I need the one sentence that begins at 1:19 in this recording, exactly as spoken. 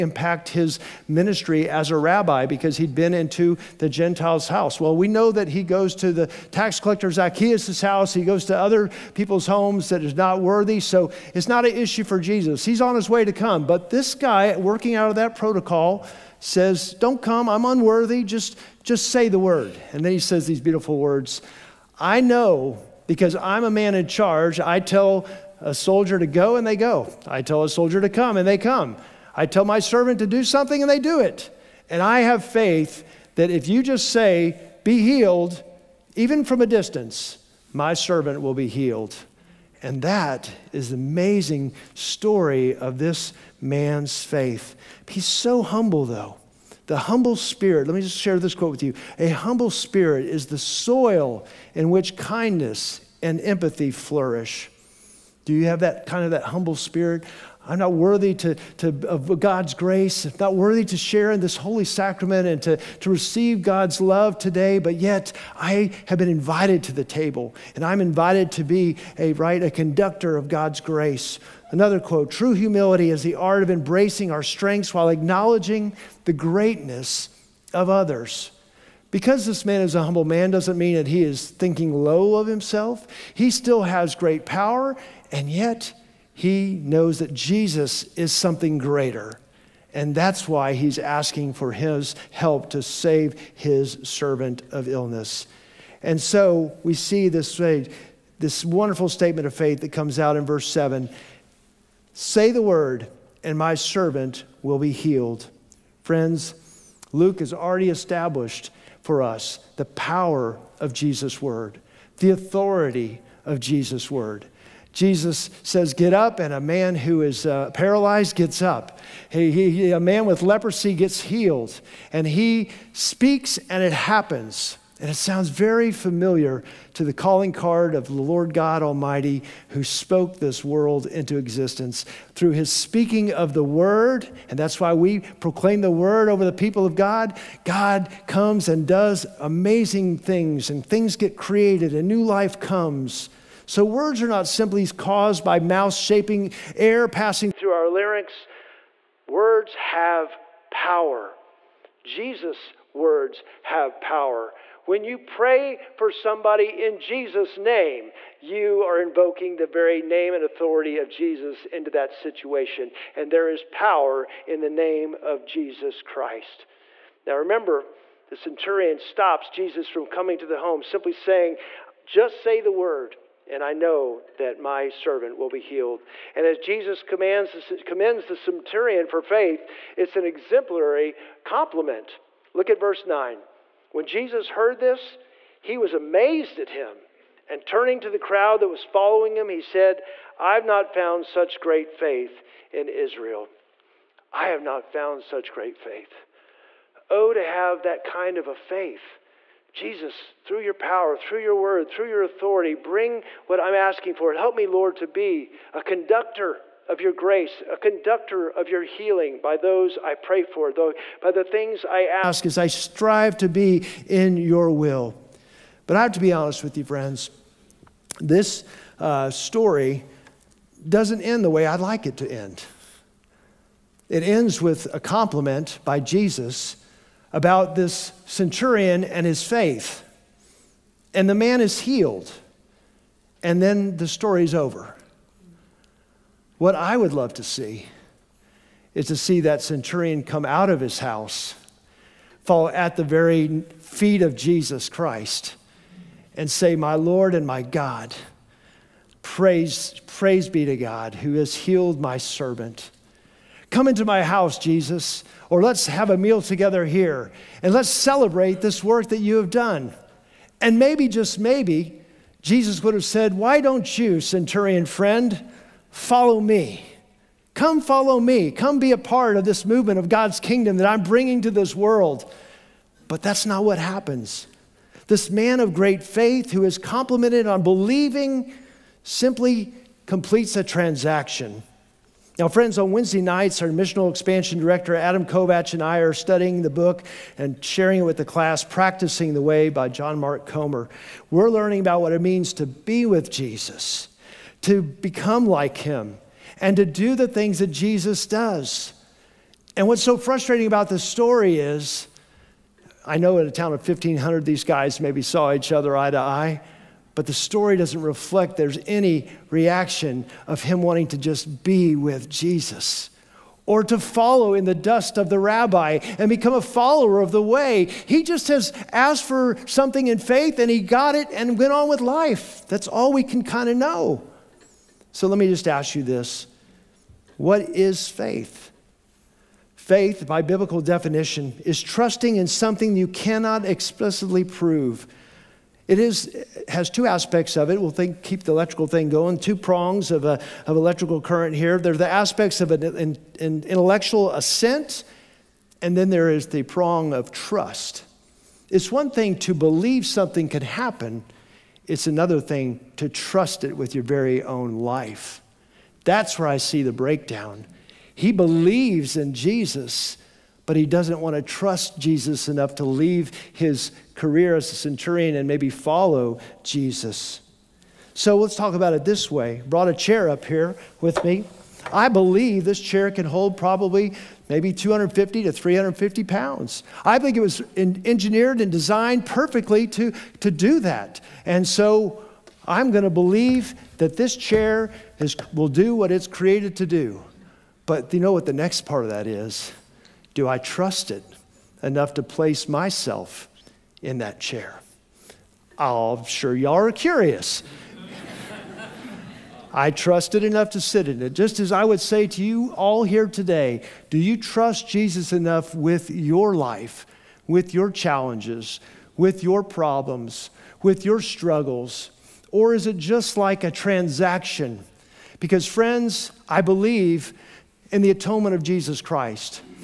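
Because this man is a humble man doesn't mean that he is thinking low of himself.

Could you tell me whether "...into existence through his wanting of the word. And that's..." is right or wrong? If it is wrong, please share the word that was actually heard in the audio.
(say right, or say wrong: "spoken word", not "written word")
wrong: "speaking", not "wanting".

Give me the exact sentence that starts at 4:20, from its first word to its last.
And maybe, just maybe, Jesus would have said, Why don't you, centurion friend?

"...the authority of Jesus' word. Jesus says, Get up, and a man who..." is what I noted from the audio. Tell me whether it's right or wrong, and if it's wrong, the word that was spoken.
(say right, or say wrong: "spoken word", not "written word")
right.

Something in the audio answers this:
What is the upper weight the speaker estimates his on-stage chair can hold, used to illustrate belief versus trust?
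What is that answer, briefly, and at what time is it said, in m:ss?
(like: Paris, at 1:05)
350 pounds, at 6:15.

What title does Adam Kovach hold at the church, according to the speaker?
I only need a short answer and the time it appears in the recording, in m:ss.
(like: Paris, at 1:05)
Missional expansion director, at 4:43.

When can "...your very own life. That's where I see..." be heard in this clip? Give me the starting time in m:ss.
5:53.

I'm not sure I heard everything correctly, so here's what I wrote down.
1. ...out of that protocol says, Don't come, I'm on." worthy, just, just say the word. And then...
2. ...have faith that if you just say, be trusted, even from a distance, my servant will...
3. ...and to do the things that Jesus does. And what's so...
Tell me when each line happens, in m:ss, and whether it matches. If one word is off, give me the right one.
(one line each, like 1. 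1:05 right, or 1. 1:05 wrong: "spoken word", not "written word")
1. 0:14 wrong: "unworthy", not "worthy"
2. 0:32 wrong: "healed", not "trusted"
3. 4:56 right.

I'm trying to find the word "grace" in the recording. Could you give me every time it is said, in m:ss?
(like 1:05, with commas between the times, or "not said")
0:59, 1:10, 3:27.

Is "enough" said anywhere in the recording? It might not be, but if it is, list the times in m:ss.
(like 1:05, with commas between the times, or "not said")
6:02, 6:31, 6:40, 6:45.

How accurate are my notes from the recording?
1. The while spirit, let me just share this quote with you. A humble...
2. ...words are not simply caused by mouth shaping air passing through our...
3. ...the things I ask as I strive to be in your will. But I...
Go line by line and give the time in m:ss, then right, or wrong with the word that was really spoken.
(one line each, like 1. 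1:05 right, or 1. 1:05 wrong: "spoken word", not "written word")
1. 0:46 wrong: "humble", not "while"
2. 2:23 right
3. 3:31 right.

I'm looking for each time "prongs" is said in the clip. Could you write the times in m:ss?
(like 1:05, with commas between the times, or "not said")
5:39, 5:46.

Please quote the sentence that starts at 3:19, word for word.
Jesus, through your power, through your word, through your authority, bring what I'm asking for.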